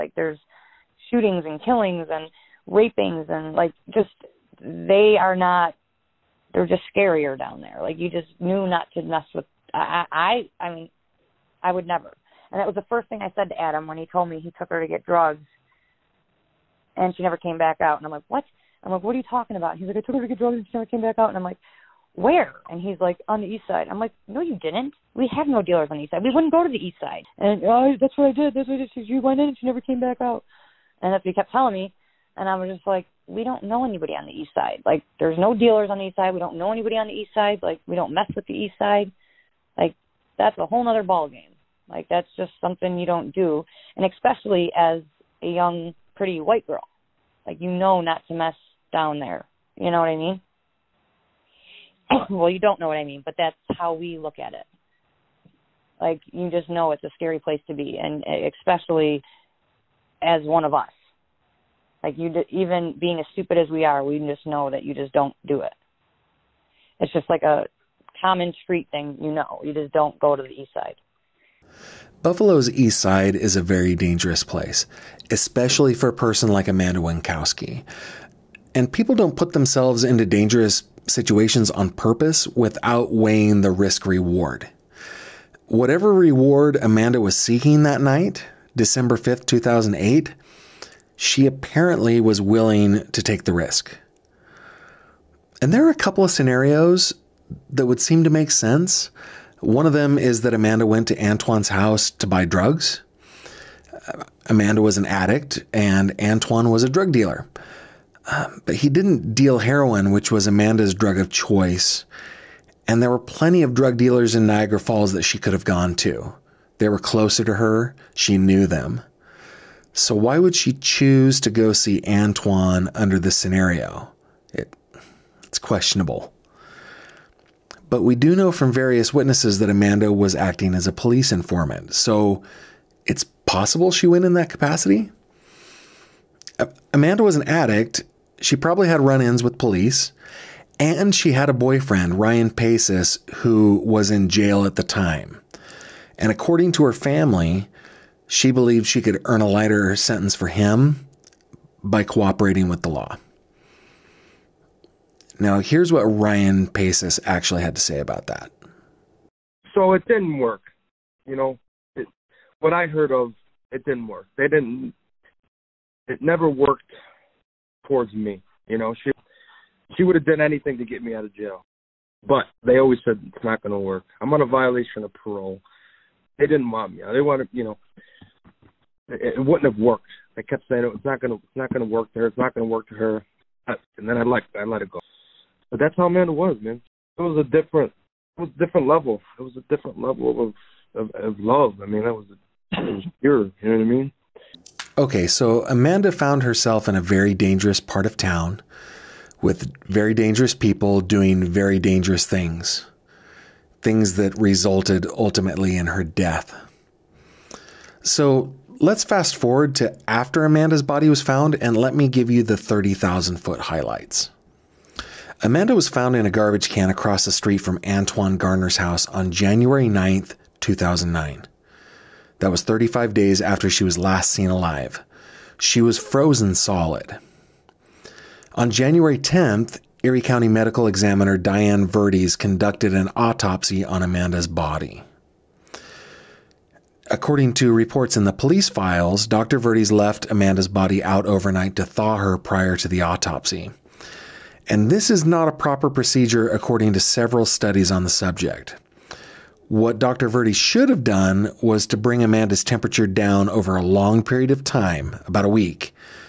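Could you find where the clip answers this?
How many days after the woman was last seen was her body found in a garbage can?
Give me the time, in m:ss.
3:42.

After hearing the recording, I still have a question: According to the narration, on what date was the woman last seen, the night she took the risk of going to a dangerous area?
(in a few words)
December 5th, 2008.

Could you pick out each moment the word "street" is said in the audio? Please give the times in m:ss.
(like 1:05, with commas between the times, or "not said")
1:08, 3:37.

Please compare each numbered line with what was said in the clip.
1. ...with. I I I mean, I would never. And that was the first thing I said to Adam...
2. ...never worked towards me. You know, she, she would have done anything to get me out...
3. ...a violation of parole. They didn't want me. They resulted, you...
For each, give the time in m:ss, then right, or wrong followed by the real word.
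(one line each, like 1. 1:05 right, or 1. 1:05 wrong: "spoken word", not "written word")
1. 0:09 right
2. 2:46 right
3. 2:54 wrong: "wanted", not "resulted".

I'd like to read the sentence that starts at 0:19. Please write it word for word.
He's like, I took her to get drugs and she never came back out.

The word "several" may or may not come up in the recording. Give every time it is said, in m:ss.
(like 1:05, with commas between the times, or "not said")
4:06.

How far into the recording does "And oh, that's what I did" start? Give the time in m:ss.
0:27.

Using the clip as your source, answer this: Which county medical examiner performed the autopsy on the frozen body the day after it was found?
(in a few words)
Diane Verdes.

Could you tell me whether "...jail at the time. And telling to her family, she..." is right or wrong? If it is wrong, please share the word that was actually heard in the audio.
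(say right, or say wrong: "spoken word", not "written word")
wrong: "according", not "telling".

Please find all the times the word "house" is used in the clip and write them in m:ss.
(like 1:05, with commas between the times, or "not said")
1:41, 3:38.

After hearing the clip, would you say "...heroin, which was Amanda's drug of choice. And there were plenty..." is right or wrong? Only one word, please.
right.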